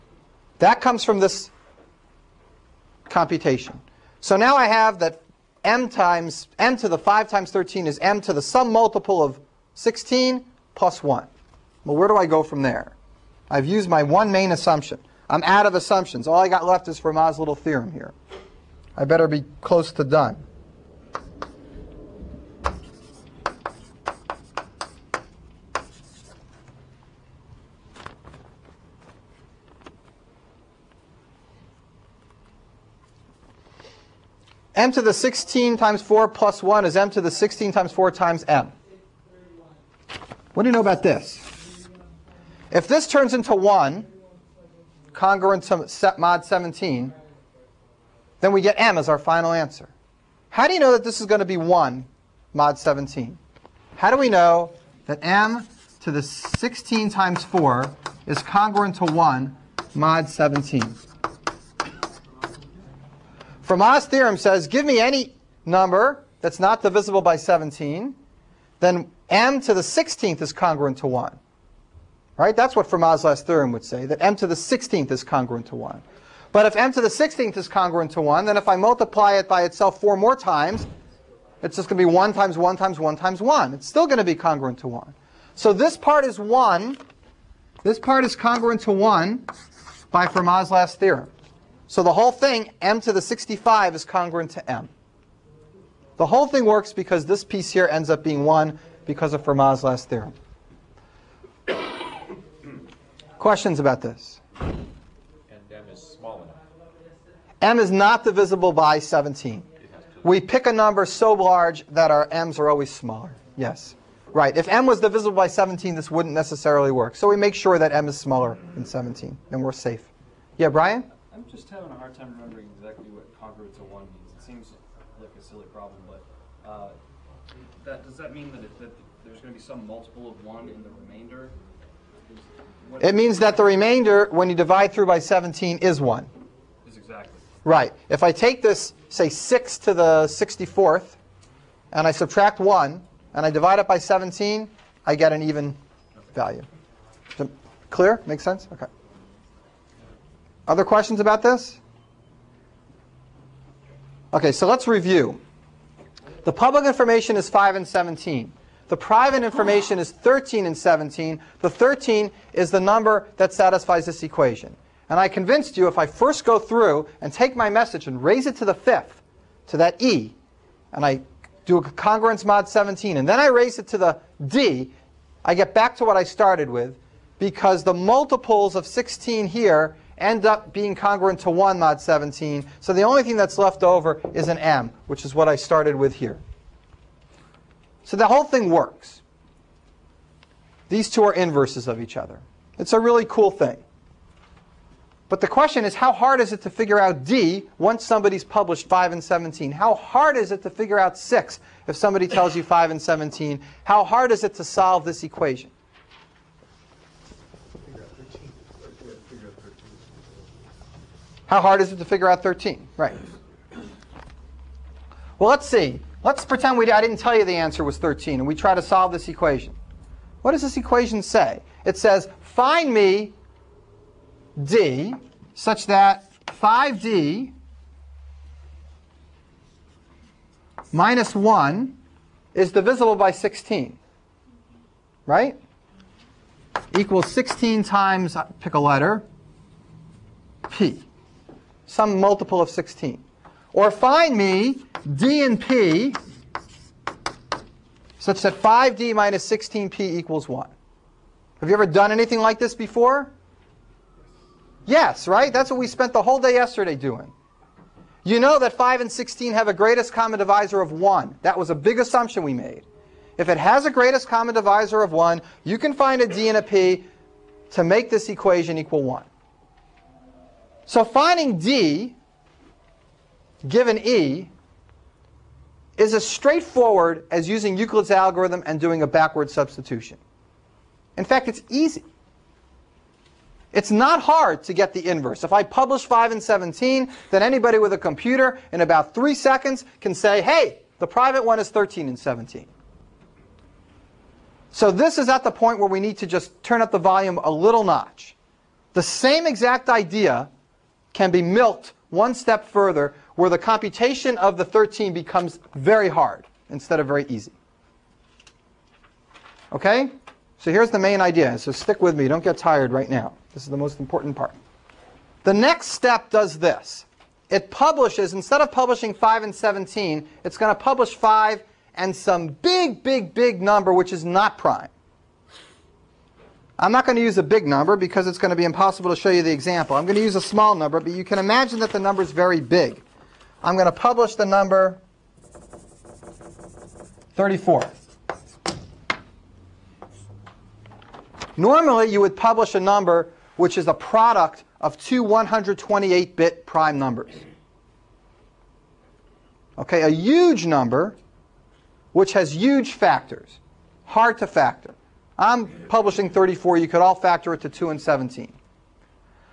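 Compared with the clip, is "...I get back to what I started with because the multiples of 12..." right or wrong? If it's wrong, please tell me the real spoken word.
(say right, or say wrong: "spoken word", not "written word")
wrong: "16", not "12".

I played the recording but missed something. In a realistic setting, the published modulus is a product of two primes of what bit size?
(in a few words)
128-bit.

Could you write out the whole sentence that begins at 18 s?
I better be close to done.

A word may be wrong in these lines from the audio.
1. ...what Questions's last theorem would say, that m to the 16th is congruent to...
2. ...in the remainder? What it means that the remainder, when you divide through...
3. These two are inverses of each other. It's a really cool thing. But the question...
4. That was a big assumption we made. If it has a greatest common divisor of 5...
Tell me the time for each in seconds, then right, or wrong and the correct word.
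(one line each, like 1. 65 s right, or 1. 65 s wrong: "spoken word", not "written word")
1. 72 s wrong: "Fermat", not "Questions"
2. 130 s right
3. 190 s right
4. 261 s wrong: "1", not "5".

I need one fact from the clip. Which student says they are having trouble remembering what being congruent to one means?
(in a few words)
Brian.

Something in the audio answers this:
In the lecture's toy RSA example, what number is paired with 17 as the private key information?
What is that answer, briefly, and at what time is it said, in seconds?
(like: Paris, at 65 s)
13, at 158 s.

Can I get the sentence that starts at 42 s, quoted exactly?
If this turns into 1, congruent to mod 17, then we get m as our final answer.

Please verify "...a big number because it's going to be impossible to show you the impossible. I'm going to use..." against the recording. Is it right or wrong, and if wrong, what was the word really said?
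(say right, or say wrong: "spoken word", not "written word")
wrong: "example", not "impossible".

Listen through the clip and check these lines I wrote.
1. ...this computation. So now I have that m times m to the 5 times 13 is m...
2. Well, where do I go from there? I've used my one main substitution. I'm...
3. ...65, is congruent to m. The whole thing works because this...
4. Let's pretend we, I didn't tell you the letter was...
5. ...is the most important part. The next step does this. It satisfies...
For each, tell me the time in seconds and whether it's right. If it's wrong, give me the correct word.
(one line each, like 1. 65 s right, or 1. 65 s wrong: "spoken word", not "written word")
1. 1 s right
2. 11 s wrong: "assumption", not "substitution"
3. 93 s right
4. 216 s wrong: "answer", not "letter"
5. 313 s wrong: "publishes", not "satisfies".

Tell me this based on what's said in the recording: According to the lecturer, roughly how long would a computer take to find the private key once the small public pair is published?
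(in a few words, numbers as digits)
3 seconds.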